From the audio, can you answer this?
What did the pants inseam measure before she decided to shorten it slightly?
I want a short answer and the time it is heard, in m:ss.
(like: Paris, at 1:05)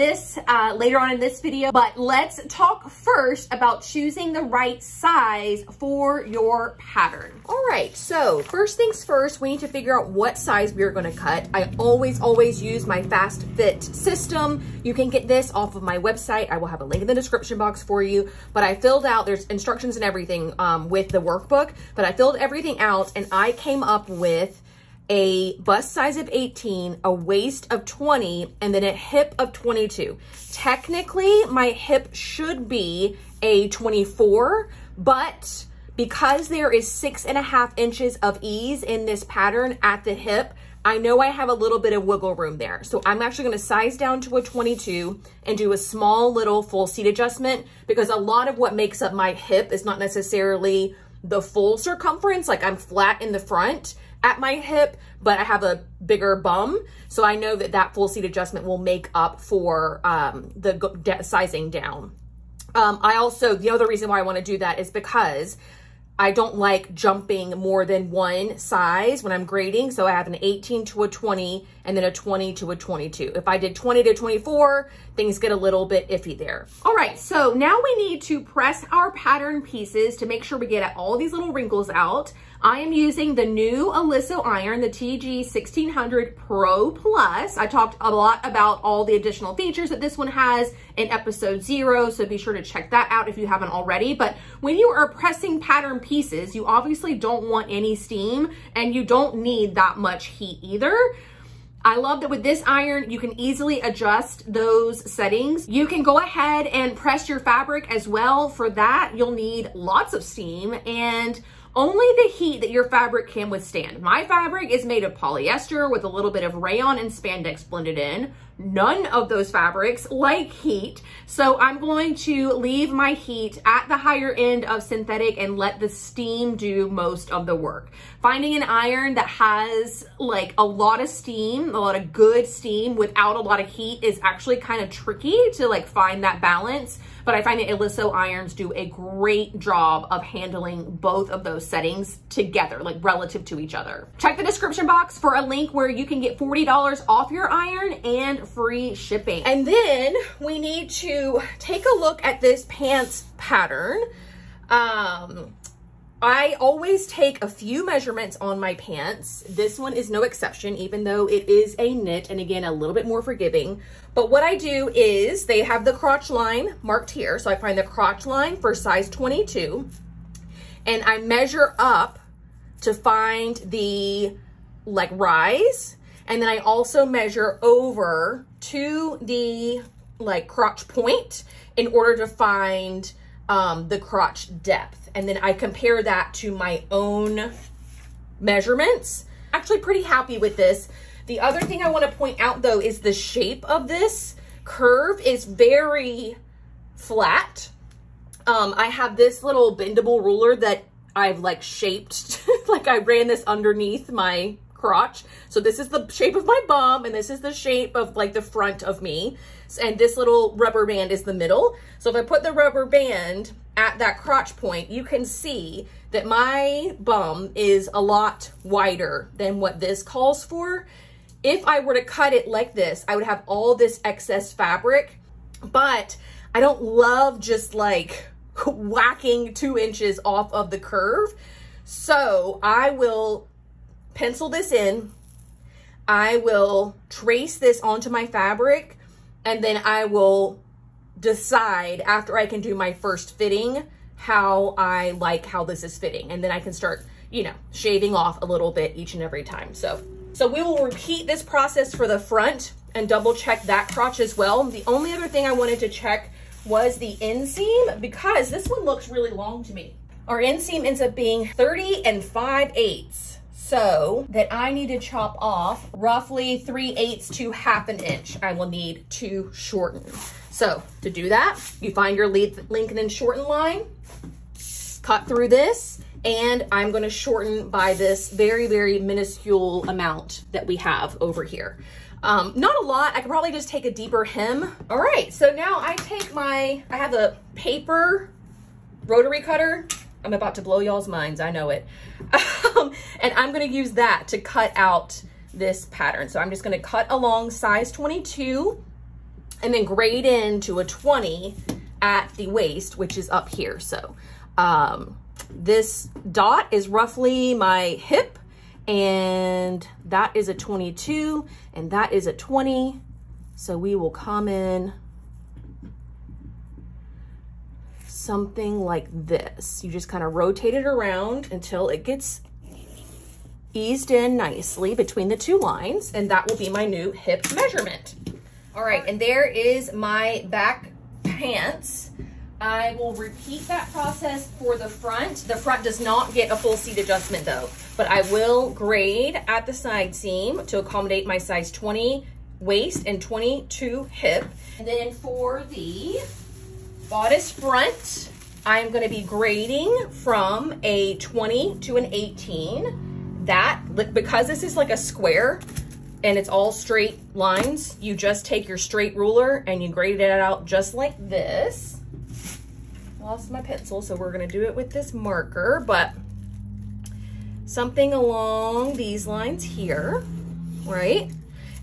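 30 5/8, at 4:21.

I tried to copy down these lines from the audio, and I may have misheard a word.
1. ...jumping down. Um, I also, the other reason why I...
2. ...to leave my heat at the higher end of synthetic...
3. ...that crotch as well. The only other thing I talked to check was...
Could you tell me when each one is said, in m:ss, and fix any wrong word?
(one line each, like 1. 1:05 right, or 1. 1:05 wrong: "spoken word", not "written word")
1. 1:01 wrong: "sizing", not "jumping"
2. 2:02 right
3. 4:13 wrong: "wanted", not "talked".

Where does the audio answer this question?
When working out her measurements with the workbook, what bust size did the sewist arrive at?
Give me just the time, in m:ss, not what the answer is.
0:25.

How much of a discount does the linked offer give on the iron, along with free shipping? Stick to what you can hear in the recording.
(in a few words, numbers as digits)
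$40.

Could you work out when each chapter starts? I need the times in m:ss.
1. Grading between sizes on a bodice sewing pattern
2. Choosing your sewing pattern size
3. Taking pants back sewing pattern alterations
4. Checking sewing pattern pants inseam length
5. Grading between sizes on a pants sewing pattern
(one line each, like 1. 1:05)
1. 5:46
2. 0:07
3. 2:29
4. 4:14
5. 4:59.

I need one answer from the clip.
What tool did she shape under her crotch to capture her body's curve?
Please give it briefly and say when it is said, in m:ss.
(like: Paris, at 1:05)
bendable ruler, at 3:19.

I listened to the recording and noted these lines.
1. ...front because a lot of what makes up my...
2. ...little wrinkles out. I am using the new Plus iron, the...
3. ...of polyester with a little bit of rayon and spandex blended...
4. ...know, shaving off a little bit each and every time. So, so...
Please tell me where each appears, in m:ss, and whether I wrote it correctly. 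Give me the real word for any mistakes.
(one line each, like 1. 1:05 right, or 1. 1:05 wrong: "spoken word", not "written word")
1. 0:47 wrong: "adjustment", not "front"
2. 1:21 wrong: "Oliso", not "Plus"
3. 1:55 right
4. 4:07 right.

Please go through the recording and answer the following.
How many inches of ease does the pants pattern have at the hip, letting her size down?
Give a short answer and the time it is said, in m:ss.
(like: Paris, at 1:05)
6 and a half inches, at 0:36.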